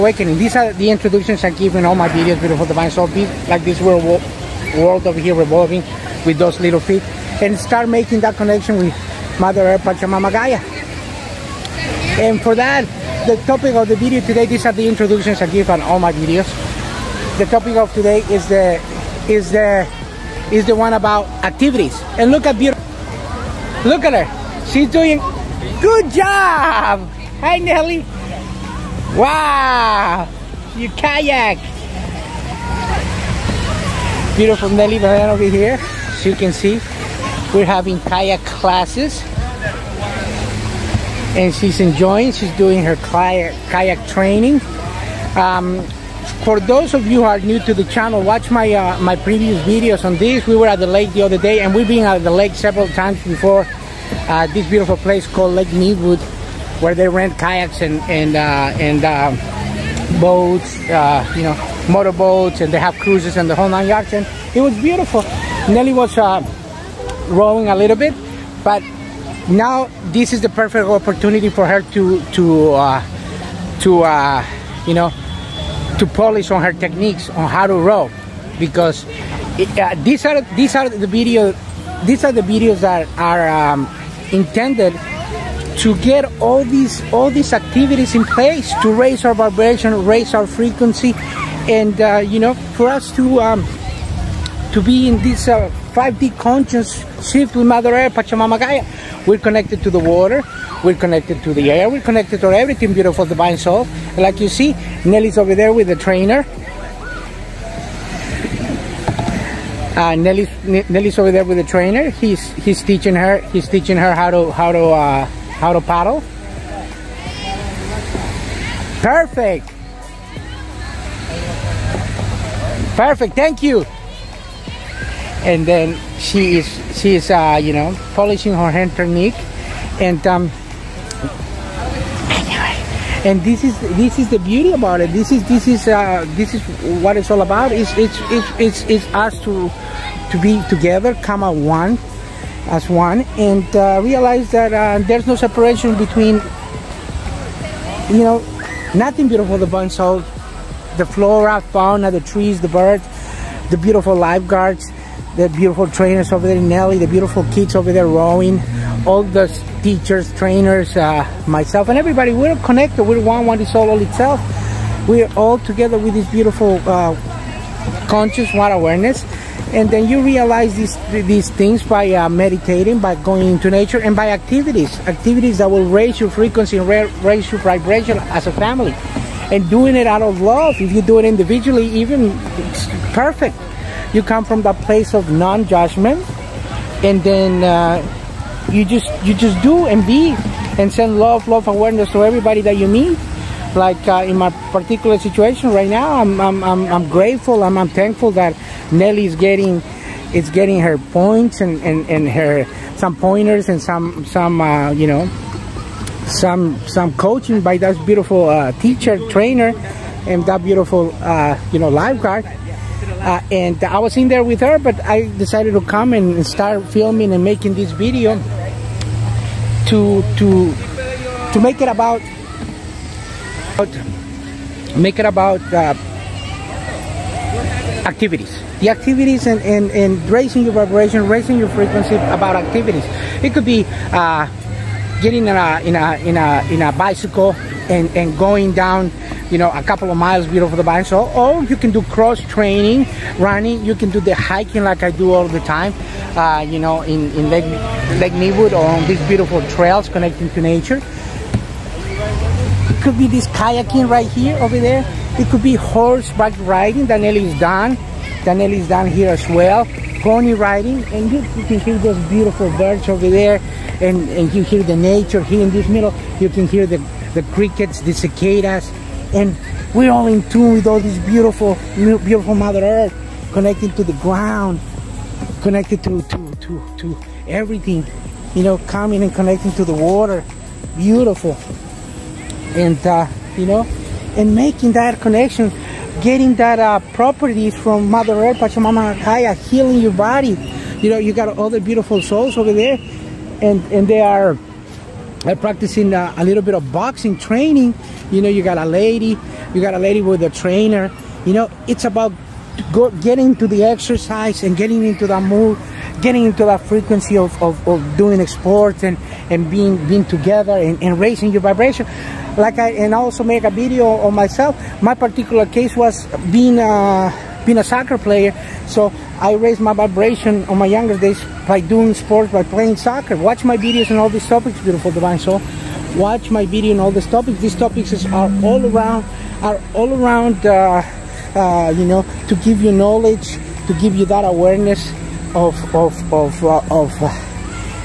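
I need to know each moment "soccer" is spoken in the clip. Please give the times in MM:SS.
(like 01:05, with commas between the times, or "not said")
05:17, 05:22.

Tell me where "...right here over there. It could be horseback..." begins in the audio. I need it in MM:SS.
04:14.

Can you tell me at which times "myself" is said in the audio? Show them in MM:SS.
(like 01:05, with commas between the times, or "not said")
02:41, 05:14.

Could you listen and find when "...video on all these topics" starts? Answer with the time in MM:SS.
05:26.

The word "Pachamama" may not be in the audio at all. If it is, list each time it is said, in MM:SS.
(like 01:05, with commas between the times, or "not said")
00:09, 01:38, 04:48.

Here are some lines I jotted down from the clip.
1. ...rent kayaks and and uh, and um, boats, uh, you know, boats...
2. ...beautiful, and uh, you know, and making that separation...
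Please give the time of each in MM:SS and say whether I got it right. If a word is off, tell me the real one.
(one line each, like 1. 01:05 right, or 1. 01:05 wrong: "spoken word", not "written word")
1. 00:57 wrong: "motorboats", not "boats"
2. 04:40 wrong: "connection", not "separation".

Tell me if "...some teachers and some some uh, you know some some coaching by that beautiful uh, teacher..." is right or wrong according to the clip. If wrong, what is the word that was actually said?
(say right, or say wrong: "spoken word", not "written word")
wrong: "pointers", not "teachers".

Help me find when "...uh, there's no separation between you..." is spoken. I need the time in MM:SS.
02:24.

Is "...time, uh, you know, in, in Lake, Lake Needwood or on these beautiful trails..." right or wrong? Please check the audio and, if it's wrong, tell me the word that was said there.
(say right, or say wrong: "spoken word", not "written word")
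right.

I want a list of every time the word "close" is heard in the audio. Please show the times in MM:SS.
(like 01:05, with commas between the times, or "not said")
not said.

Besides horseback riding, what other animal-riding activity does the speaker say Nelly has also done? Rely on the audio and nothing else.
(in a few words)
Pony riding.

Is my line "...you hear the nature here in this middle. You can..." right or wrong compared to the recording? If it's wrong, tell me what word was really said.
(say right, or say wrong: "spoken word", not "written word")
right.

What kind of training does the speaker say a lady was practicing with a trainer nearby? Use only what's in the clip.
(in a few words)
boxing.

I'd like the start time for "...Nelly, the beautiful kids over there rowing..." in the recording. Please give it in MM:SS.
02:36.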